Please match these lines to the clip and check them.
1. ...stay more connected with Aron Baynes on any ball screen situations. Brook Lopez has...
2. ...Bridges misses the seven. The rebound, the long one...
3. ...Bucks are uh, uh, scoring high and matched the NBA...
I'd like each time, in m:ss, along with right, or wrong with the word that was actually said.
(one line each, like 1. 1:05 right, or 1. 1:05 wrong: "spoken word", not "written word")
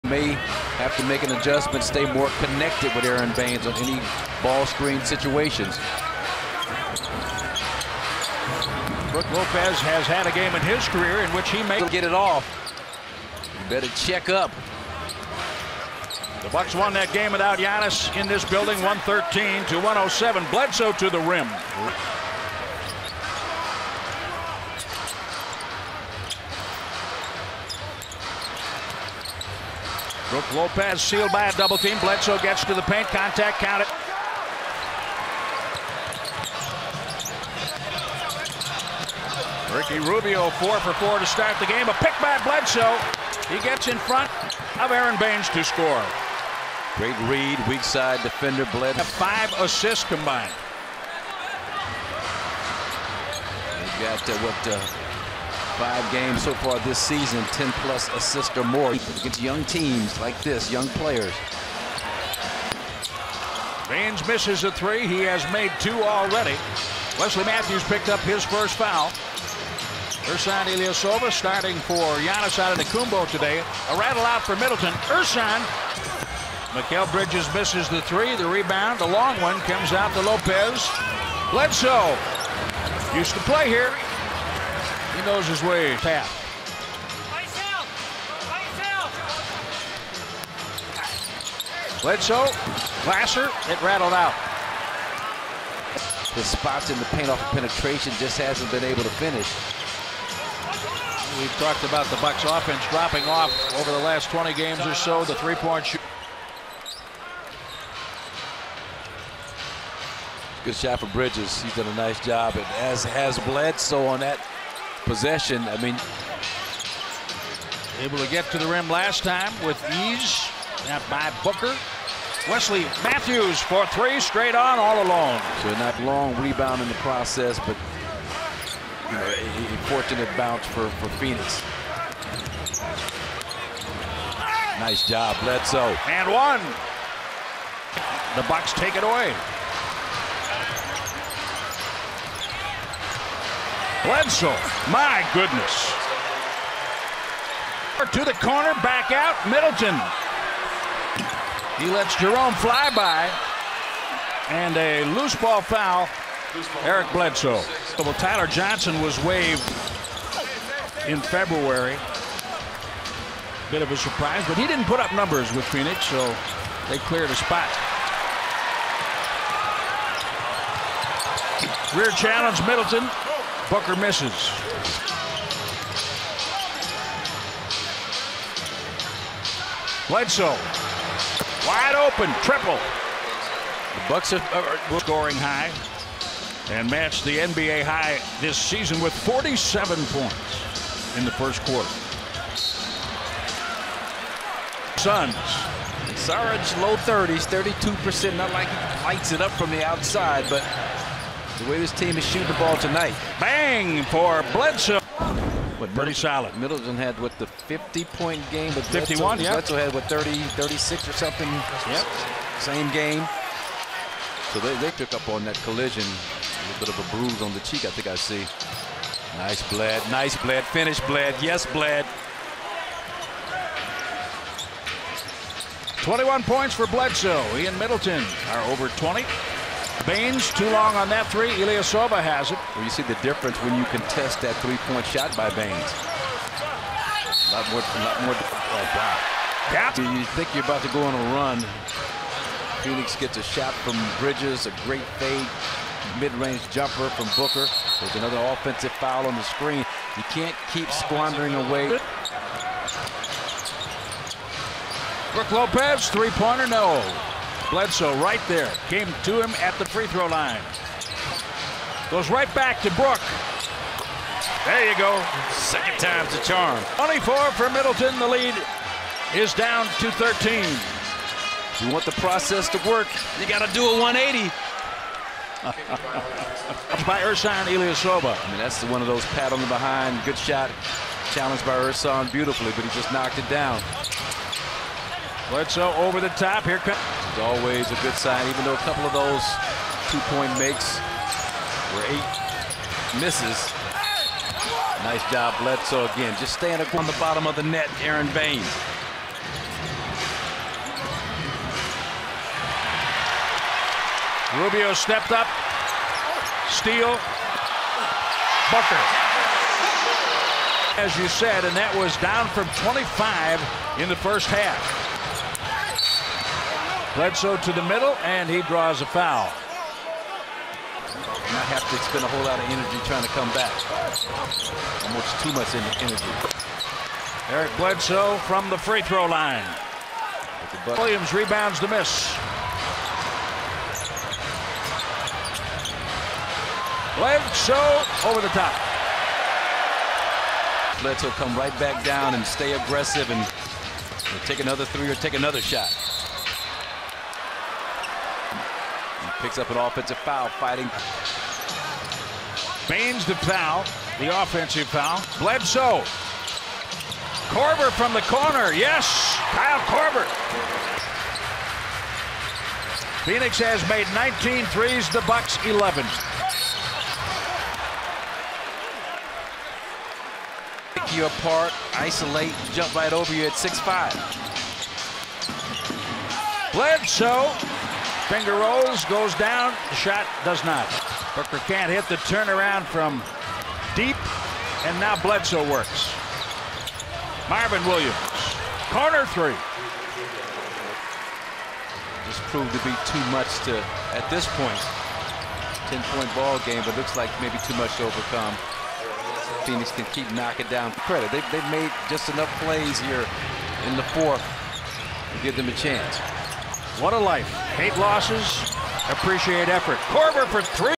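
1. 0:01 right
2. 1:17 wrong: "three", not "seven"
3. 3:04 right.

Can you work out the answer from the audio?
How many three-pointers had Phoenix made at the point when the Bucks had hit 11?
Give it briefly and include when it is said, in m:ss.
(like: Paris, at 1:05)
19, at 6:04.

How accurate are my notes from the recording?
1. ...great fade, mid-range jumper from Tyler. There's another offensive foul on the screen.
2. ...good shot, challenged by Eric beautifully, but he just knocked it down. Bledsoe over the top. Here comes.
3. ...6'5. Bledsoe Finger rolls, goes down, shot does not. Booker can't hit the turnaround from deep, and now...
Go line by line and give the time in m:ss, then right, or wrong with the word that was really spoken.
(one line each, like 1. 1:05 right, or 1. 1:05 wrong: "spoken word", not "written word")
1. 4:04 wrong: "Booker", not "Tyler"
2. 4:40 wrong: "Ersan", not "Eric"
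3. 6:13 right.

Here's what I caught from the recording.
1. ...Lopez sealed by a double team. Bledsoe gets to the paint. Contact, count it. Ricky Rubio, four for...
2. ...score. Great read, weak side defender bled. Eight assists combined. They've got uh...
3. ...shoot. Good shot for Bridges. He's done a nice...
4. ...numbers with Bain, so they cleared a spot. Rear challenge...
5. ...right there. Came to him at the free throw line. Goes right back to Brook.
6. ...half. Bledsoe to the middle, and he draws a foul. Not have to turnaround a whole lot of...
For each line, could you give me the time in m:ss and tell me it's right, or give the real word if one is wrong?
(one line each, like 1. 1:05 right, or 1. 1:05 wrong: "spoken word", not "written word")
1. 0:30 right
2. 0:45 wrong: "Five", not "Eight"
3. 1:45 right
4. 2:45 wrong: "Phoenix", not "Bain"
5. 4:18 right
6. 5:14 wrong: "spend", not "turnaround".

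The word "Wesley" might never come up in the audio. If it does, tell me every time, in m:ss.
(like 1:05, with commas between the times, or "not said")
1:07, 2:02.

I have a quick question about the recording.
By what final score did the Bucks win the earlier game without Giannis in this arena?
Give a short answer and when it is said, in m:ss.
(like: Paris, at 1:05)
113 to 107, at 0:18.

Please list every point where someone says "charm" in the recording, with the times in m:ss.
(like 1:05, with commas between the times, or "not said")
4:26.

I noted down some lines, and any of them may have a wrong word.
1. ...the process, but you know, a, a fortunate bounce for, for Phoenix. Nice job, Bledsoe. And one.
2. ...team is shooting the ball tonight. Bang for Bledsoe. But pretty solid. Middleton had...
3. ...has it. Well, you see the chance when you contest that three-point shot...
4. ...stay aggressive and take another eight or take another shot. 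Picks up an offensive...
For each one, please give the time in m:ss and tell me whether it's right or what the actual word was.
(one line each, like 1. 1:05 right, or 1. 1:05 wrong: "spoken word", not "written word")
1. 2:06 right
2. 3:21 right
3. 3:52 wrong: "difference", not "chance"
4. 5:42 wrong: "three", not "eight".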